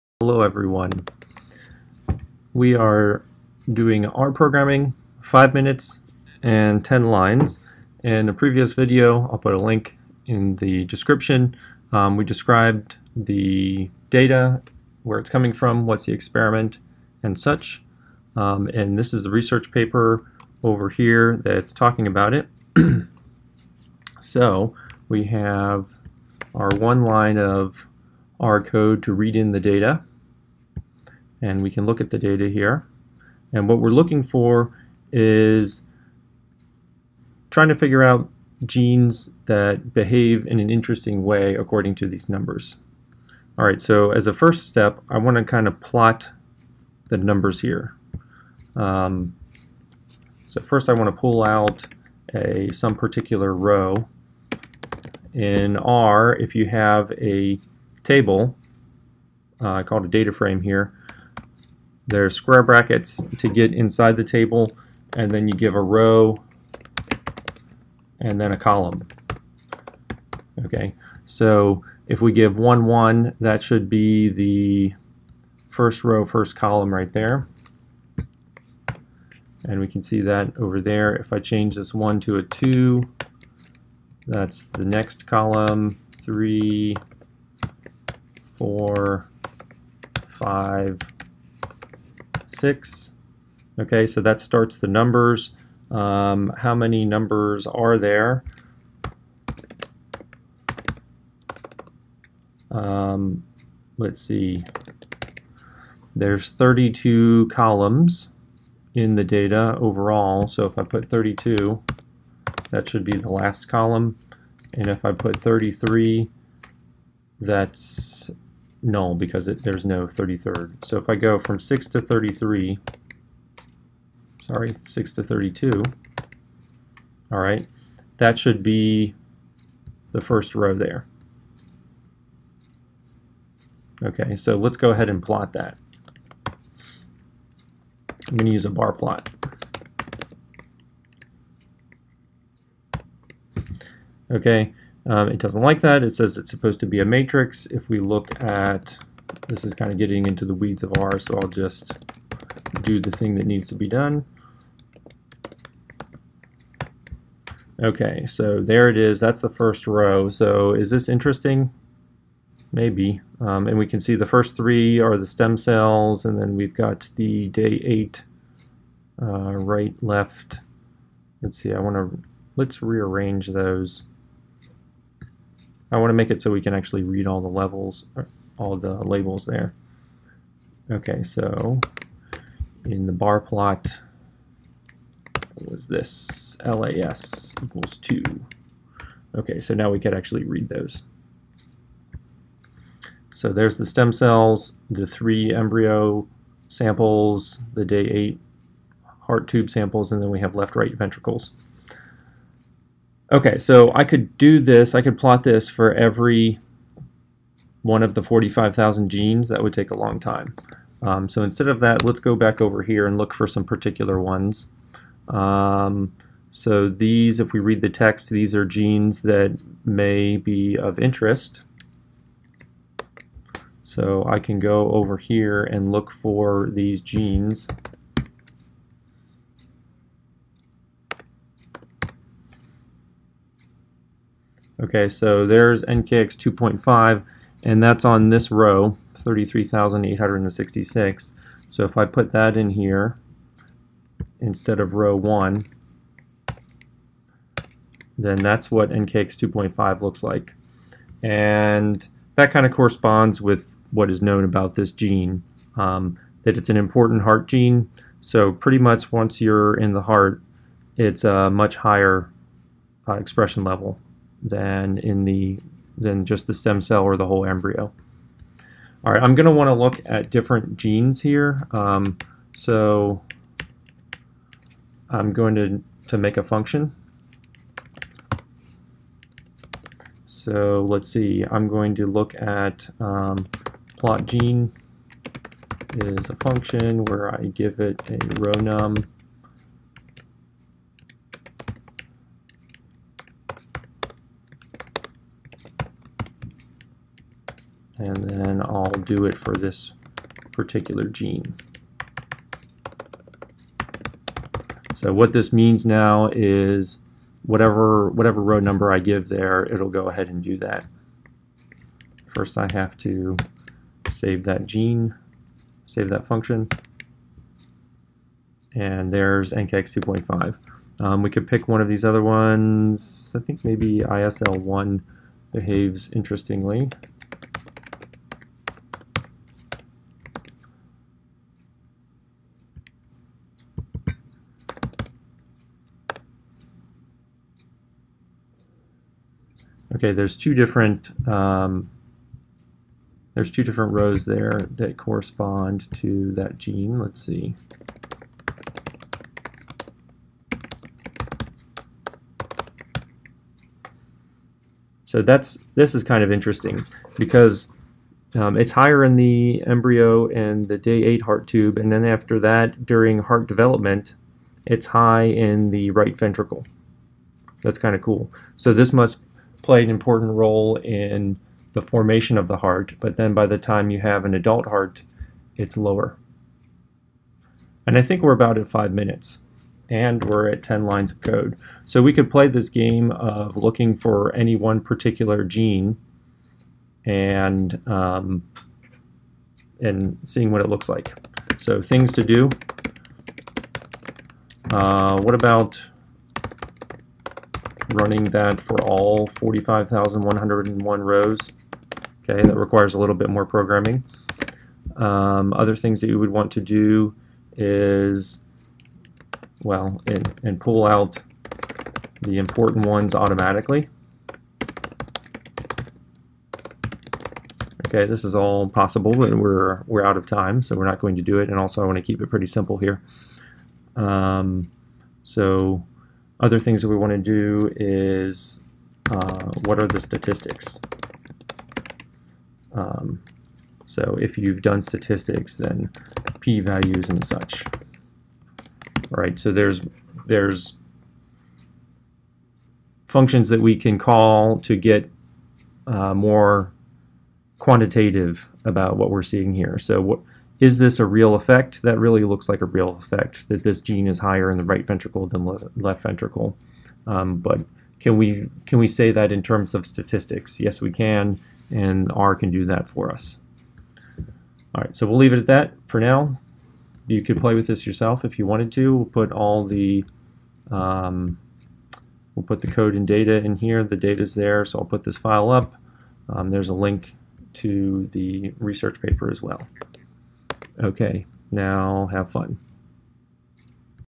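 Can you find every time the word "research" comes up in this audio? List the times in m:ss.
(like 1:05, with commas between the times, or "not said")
0:19, 7:58.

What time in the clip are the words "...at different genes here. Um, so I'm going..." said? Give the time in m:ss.
4:30.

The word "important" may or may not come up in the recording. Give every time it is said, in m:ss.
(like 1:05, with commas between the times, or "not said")
4:16, 6:09, 6:52.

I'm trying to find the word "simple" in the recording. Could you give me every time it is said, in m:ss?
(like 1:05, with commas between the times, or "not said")
7:02.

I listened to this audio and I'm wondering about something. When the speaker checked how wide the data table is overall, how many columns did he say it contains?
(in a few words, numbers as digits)
32.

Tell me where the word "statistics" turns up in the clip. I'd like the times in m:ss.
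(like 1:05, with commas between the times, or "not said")
7:10, 7:14, 7:39.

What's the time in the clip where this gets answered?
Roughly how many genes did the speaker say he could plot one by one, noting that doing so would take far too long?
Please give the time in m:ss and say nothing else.
3:28.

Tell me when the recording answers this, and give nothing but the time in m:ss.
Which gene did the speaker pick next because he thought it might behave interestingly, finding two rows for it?
5:24.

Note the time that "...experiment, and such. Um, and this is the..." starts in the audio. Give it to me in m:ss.
0:16.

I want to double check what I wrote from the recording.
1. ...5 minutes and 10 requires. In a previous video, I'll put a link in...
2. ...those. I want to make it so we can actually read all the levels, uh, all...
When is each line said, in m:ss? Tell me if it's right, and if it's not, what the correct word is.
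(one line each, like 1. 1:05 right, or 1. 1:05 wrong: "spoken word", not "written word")
1. 0:05 wrong: "lines", not "requires"
2. 2:53 right.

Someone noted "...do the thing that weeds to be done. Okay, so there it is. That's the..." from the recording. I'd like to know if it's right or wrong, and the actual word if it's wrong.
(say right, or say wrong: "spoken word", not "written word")
wrong: "needs", not "weeds".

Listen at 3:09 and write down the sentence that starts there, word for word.
Okay, so now we could actually read those.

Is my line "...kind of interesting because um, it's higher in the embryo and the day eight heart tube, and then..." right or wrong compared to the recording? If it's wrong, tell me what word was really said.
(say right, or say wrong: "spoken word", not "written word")
right.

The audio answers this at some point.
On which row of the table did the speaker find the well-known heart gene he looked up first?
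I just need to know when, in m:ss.
3:59.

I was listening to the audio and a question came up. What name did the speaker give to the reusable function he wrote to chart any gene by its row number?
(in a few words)
plot gene.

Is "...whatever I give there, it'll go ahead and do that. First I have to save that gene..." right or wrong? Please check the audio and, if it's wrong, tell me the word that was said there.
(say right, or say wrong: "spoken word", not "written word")
wrong: "number", not "whatever".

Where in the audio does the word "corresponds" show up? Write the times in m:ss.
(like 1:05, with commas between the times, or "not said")
4:12, 5:44.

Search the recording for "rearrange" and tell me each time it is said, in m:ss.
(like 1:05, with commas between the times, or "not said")
2:52.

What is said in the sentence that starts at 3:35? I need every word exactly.
Um, so these, if we read the text, these are genes that may be of interest.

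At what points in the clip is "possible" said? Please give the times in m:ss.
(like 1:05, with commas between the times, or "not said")
6:58.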